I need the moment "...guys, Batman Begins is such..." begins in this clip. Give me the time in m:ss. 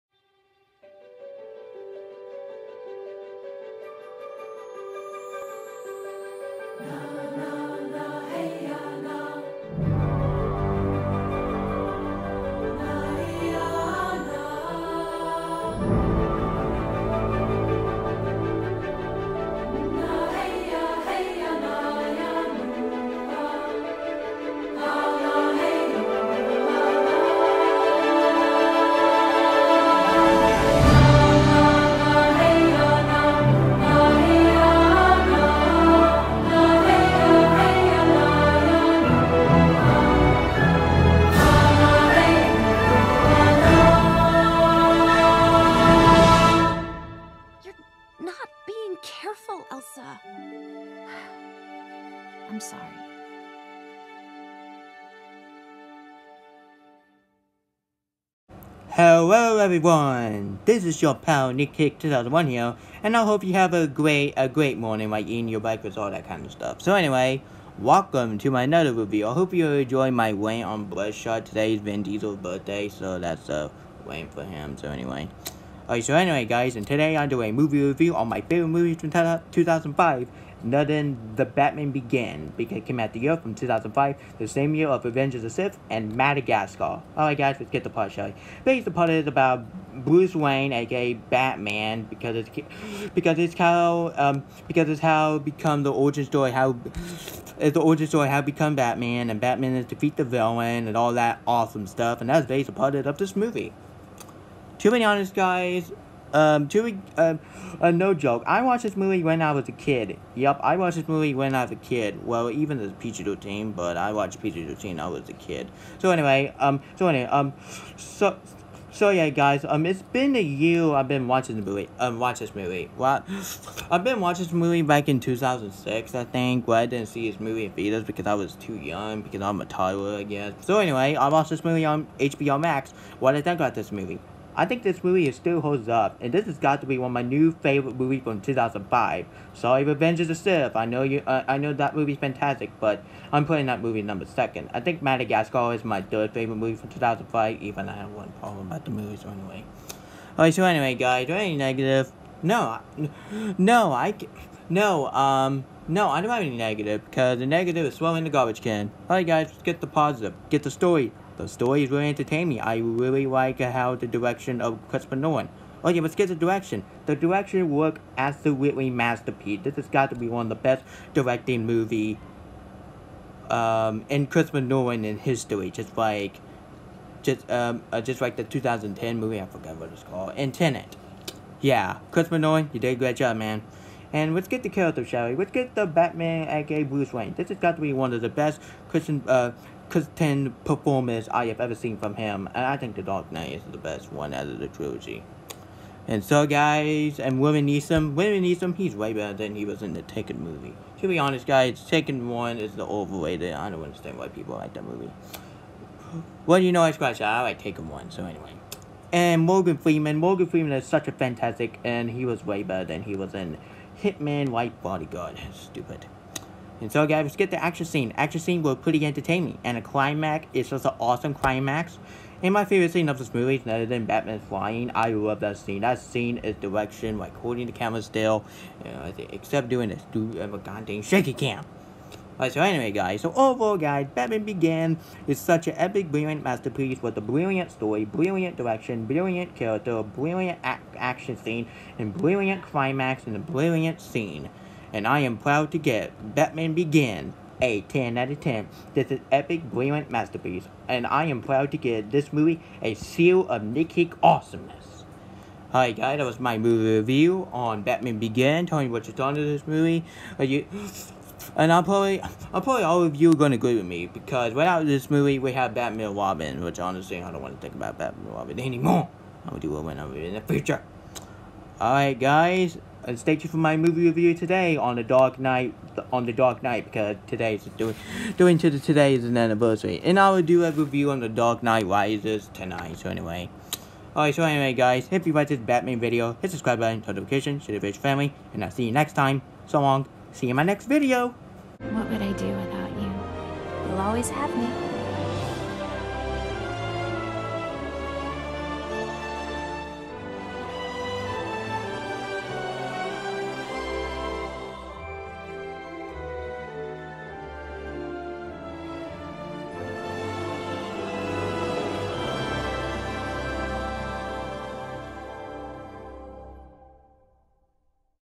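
3:53.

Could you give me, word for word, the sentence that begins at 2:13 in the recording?
What did I think about this movie?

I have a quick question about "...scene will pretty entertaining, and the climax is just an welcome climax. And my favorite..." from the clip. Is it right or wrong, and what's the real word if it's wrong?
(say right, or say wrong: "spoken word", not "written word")
wrong: "awesome", not "welcome".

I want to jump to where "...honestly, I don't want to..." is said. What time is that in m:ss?
4:26.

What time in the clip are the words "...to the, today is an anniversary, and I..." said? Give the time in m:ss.
4:38.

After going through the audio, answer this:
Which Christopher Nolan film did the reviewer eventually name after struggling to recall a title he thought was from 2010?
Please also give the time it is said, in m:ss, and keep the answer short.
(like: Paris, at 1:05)
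Tenet, at 3:00.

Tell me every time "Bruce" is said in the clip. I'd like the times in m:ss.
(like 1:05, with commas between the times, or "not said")
1:30, 3:06.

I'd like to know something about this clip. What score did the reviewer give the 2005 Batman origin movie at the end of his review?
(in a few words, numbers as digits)
10 out of 10.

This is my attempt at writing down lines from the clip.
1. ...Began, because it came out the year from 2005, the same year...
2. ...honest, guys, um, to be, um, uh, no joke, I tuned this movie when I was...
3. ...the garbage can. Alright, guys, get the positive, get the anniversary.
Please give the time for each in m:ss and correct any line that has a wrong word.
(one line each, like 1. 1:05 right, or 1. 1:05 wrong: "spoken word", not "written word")
1. 1:21 right
2. 1:45 wrong: "watched", not "tuned"
3. 2:38 wrong: "story", not "anniversary".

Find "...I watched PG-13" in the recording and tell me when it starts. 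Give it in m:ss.
1:53.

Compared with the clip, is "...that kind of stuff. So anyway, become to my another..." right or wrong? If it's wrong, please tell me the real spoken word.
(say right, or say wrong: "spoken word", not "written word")
wrong: "welcome", not "become".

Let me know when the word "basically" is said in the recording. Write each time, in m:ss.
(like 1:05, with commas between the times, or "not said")
1:28, 1:42.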